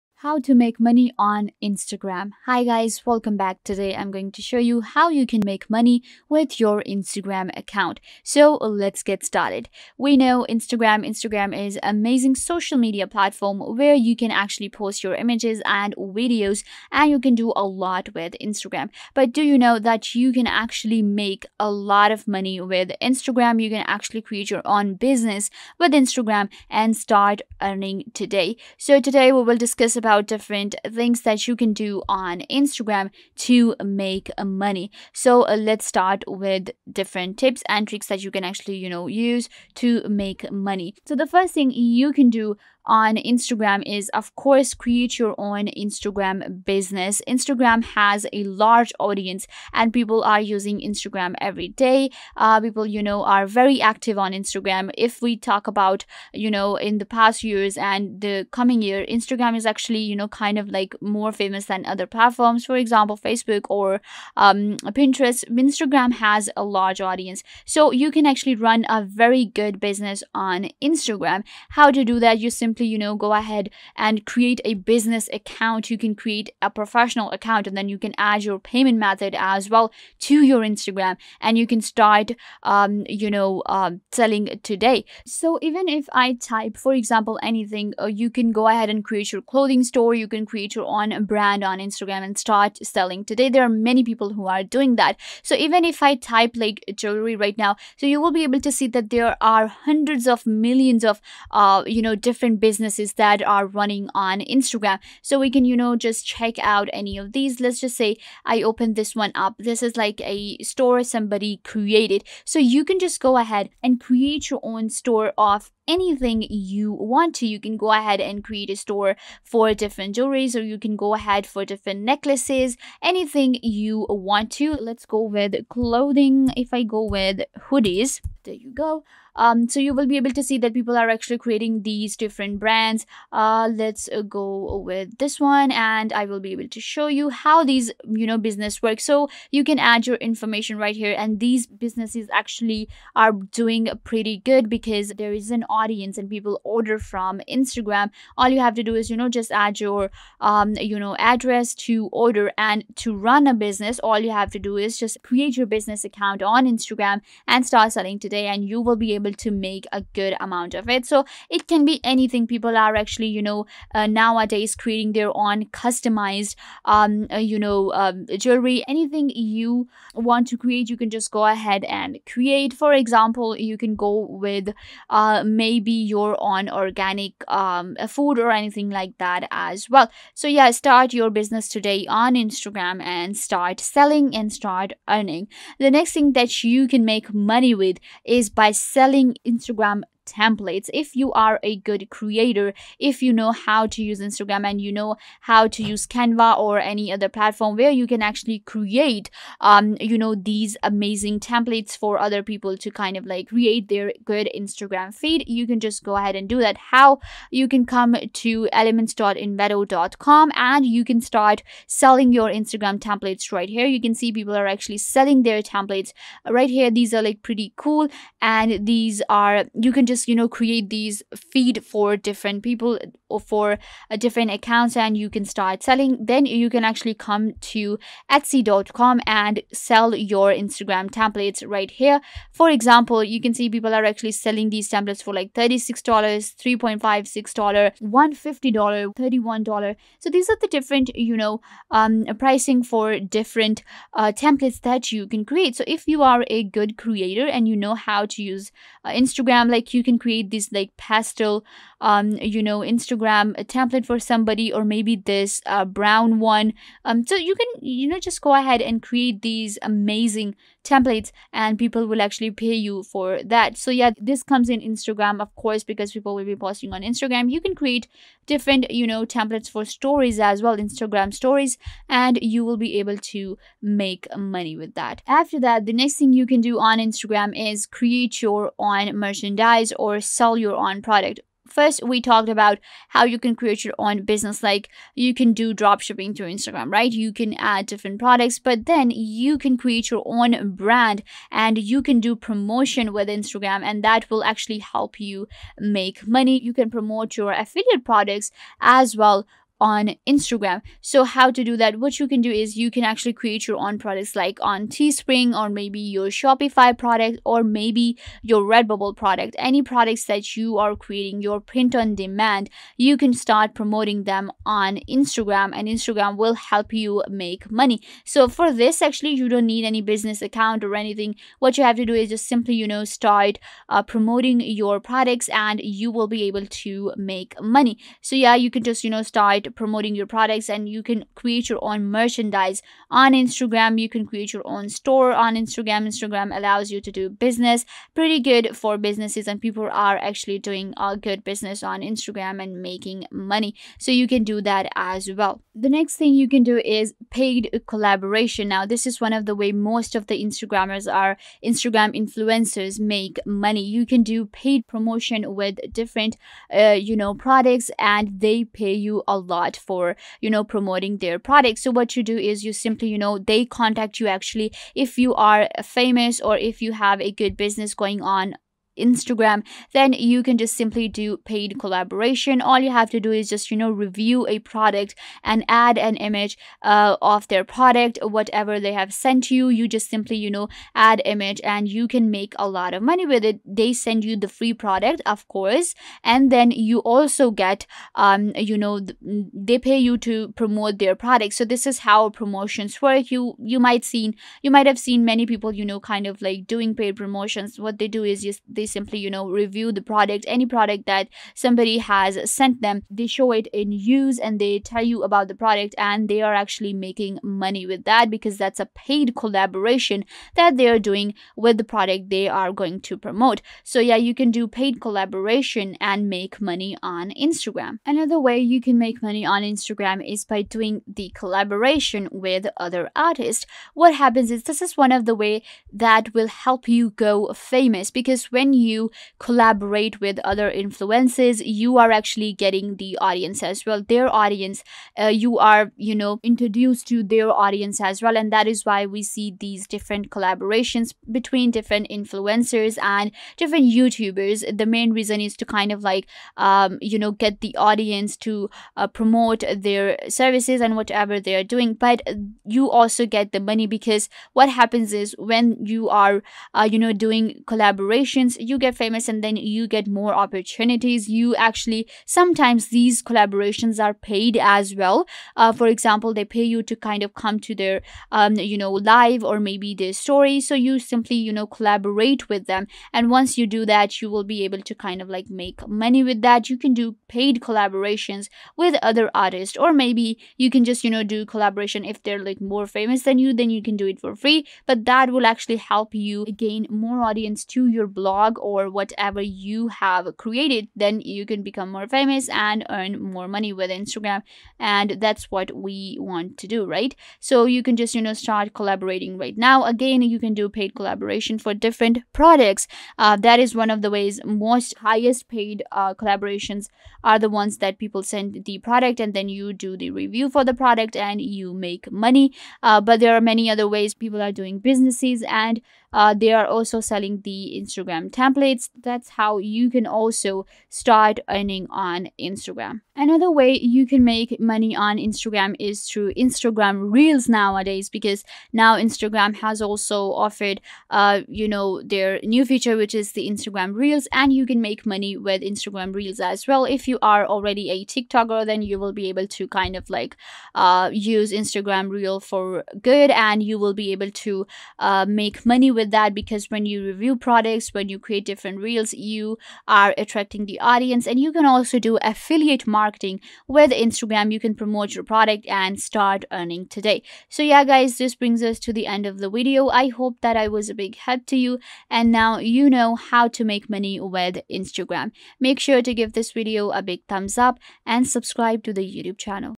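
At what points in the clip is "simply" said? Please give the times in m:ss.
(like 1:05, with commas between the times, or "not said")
1:12, 5:22, 6:02, 6:10, 6:20, 6:38, 7:50.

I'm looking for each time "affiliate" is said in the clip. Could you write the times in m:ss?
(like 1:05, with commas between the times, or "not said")
4:57, 9:12.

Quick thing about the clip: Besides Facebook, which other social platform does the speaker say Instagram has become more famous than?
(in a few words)
Pinterest.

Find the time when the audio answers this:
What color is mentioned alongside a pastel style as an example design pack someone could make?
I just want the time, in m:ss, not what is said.
4:15.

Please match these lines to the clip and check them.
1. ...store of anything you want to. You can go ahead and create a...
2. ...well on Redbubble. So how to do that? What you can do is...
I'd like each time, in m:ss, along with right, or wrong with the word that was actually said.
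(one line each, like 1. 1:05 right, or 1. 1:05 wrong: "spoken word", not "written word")
1. 1:54 right
2. 4:59 wrong: "Instagram", not "Redbubble".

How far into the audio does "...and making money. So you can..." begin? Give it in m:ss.
5:42.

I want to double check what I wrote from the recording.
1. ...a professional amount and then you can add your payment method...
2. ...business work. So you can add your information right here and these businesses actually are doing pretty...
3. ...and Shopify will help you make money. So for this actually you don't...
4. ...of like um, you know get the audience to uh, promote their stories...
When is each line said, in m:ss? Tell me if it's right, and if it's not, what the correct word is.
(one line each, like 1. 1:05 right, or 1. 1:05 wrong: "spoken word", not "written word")
1. 1:16 wrong: "account", not "amount"
2. 2:18 right
3. 5:15 wrong: "Instagram", not "Shopify"
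4. 7:25 wrong: "services", not "stories".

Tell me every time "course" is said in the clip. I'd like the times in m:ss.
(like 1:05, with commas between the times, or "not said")
0:44, 4:25, 6:25.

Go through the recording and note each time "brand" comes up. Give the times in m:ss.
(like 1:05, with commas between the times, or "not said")
1:31, 2:12, 4:50.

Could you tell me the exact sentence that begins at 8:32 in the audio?
Uh, but there are many other ways people are doing businesses and uh, they are also selling the Instagram templates.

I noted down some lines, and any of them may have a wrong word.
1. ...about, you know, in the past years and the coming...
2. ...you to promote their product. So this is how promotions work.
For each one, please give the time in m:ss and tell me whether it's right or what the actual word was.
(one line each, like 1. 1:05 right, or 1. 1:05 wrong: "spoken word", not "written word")
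1. 0:55 right
2. 6:29 right.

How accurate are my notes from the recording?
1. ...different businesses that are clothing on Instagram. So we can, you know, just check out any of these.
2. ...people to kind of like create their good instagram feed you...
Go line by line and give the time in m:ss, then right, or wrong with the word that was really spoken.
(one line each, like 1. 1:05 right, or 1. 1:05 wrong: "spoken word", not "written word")
1. 1:42 wrong: "running", not "clothing"
2. 3:22 right.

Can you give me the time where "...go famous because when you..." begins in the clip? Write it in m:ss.
7:07.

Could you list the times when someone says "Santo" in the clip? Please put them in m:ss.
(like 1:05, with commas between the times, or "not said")
not said.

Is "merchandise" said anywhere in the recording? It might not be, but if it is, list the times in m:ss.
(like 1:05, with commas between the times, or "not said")
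4:39, 5:32.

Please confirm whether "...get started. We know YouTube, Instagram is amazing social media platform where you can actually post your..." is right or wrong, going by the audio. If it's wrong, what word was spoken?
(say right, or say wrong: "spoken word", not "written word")
wrong: "Instagram", not "YouTube".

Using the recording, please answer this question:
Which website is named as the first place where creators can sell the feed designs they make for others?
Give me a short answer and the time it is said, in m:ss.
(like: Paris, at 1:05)
elements.envato.com, at 3:28.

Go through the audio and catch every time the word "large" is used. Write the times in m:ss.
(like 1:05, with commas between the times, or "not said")
0:48, 1:06.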